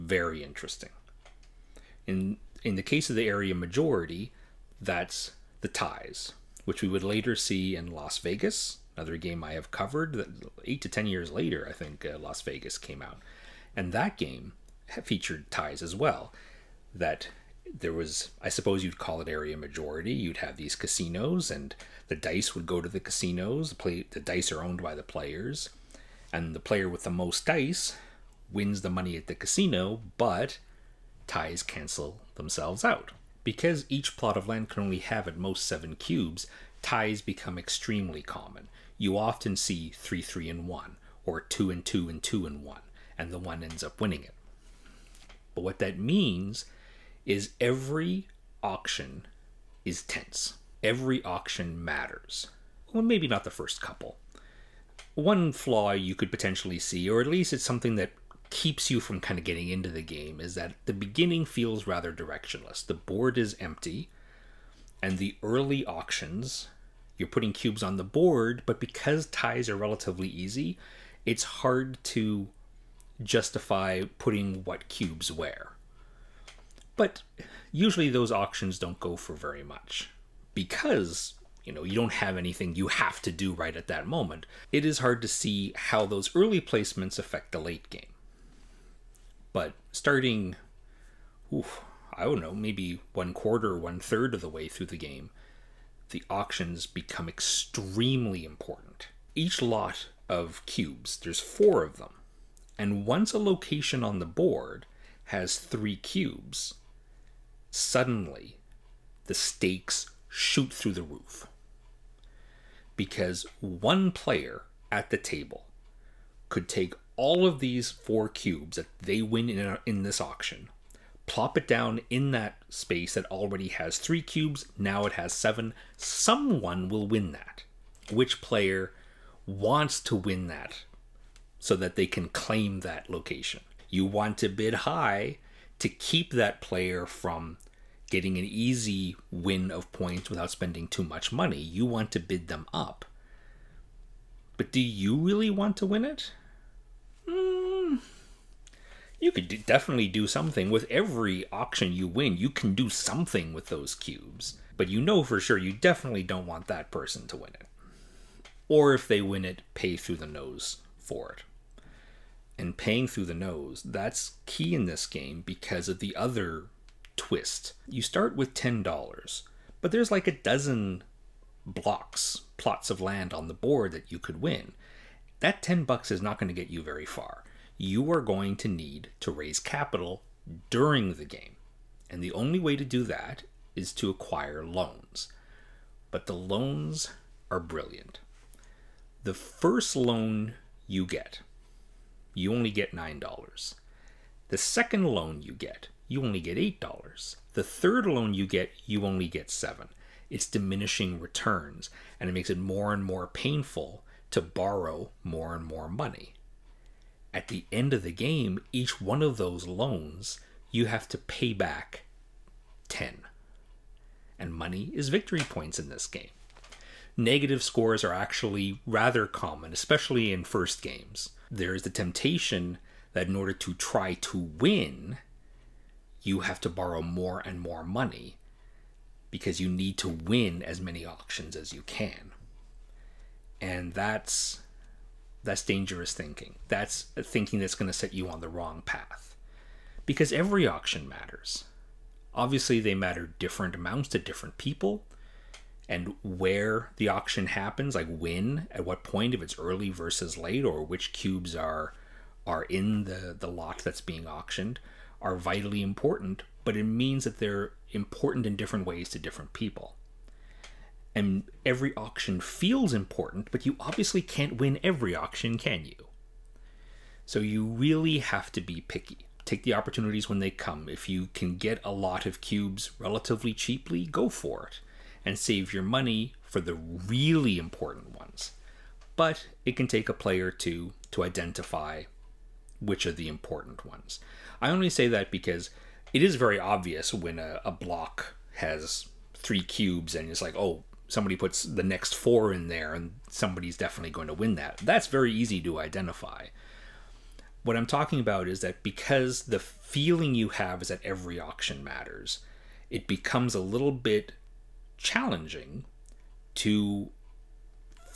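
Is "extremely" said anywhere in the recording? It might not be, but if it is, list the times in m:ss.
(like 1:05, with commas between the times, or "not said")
0:37, 1:37.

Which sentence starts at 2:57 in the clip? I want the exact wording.
You are going to need to raise capital during the game.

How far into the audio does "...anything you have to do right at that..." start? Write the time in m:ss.
1:22.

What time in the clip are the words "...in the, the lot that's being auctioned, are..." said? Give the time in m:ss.
4:12.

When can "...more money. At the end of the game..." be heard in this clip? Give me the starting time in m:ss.
3:25.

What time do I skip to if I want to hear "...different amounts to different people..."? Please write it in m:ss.
4:03.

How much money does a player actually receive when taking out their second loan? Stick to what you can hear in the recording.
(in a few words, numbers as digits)
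$8.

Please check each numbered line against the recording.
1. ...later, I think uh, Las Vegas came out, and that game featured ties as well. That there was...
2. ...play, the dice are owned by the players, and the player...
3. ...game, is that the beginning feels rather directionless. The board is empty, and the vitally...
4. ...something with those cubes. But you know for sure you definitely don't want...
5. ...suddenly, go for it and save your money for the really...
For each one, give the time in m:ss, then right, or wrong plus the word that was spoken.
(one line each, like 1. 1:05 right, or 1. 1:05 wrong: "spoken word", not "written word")
1. 0:11 right
2. 0:23 right
3. 1:00 wrong: "early", not "vitally"
4. 2:32 right
5. 4:33 wrong: "cheaply", not "suddenly".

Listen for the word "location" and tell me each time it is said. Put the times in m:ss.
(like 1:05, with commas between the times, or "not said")
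1:43, 2:13.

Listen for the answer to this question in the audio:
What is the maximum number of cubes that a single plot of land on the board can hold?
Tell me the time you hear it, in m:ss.
0:35.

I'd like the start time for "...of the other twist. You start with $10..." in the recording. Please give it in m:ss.
2:45.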